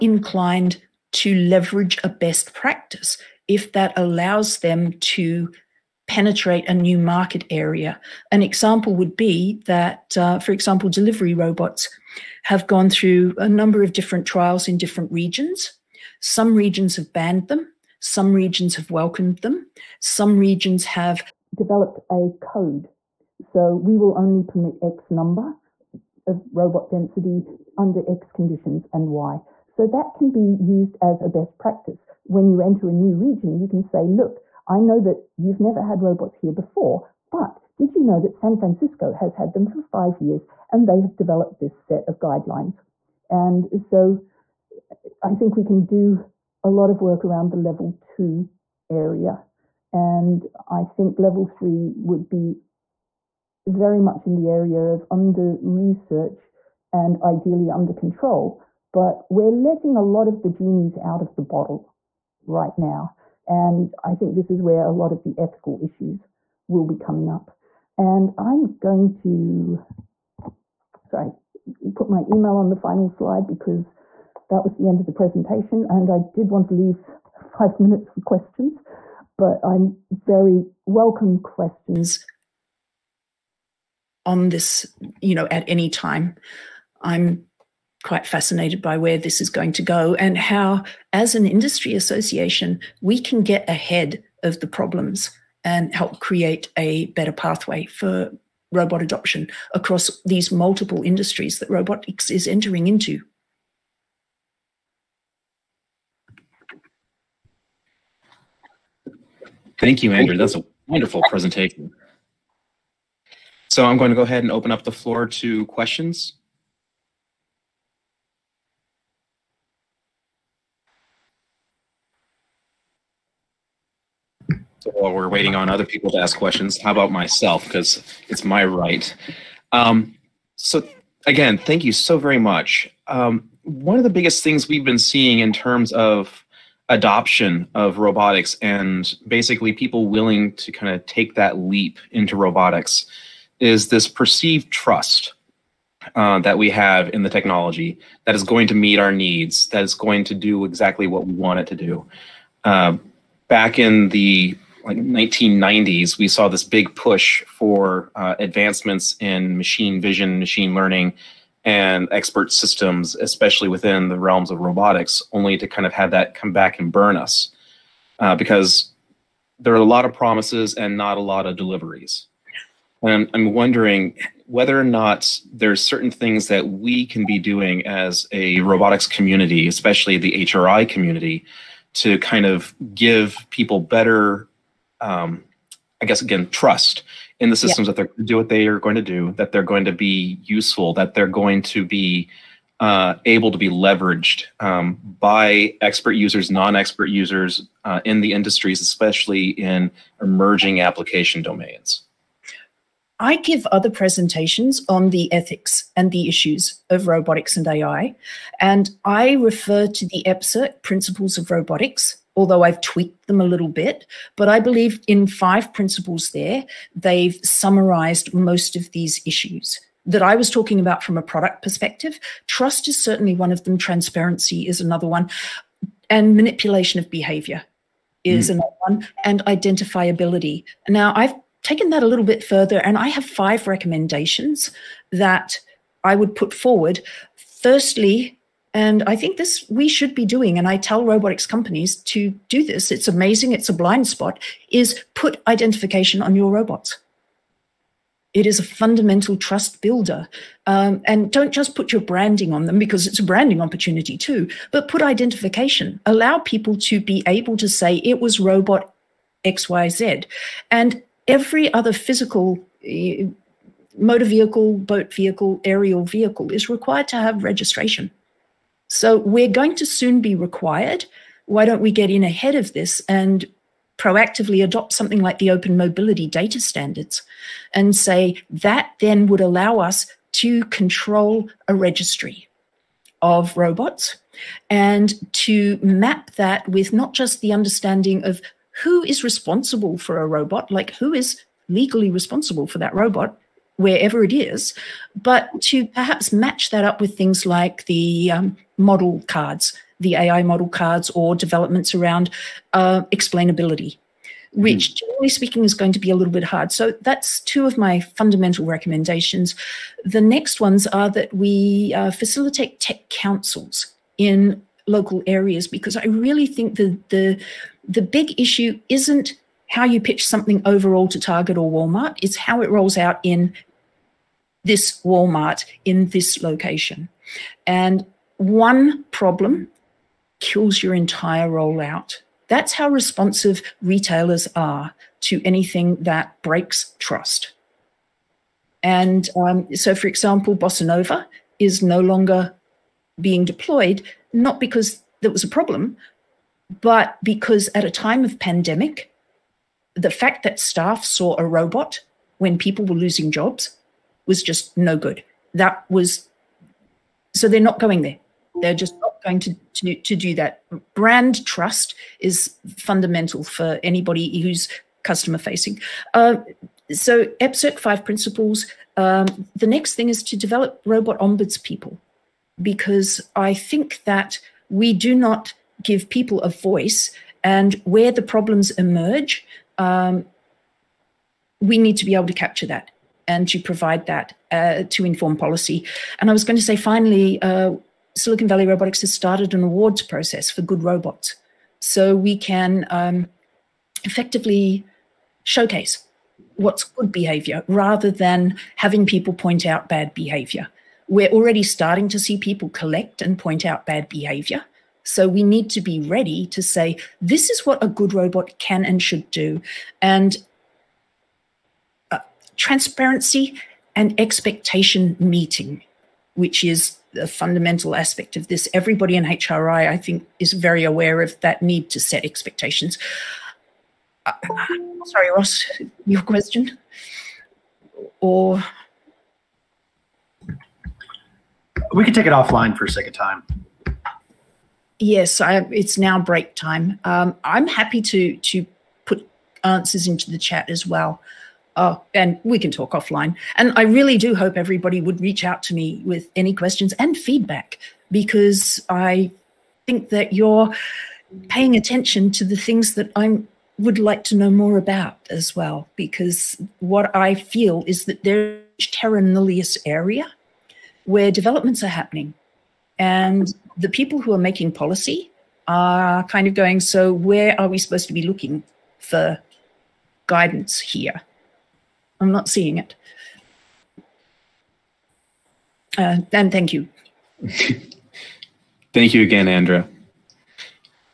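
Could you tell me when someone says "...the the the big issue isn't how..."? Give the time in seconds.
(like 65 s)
316 s.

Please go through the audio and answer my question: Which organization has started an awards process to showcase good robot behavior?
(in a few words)
Silicon Valley Robotics.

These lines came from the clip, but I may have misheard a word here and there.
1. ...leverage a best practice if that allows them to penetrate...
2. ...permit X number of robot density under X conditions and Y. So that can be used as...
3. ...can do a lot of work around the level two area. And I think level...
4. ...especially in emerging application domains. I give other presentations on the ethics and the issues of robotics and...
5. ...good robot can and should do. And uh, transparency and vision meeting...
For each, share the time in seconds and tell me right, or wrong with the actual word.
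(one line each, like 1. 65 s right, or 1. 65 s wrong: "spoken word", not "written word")
1. 1 s right
2. 24 s right
3. 45 s right
4. 198 s right
5. 407 s wrong: "expectation", not "vision".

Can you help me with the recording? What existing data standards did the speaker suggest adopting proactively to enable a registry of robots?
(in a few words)
open mobility data standards.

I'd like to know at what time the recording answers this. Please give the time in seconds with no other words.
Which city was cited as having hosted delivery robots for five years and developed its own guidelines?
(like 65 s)
38 s.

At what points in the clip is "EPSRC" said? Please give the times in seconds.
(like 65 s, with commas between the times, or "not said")
210 s, 367 s.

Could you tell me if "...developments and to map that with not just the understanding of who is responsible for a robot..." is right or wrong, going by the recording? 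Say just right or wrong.
wrong.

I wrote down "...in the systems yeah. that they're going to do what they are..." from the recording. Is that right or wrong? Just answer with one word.
right.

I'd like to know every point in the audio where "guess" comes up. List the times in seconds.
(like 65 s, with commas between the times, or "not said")
186 s.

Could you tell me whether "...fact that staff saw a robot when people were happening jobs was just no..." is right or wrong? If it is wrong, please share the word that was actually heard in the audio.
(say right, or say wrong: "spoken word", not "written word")
wrong: "losing", not "happening".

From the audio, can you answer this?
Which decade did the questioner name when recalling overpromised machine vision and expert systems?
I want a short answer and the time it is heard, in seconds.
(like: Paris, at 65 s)
1990s, at 154 s.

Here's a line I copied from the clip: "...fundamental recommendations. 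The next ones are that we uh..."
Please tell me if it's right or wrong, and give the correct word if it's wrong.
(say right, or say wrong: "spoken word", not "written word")
right.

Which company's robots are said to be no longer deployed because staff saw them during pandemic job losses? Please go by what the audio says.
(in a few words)
Bossa Nova.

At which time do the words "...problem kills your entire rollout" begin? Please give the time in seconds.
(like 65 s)
329 s.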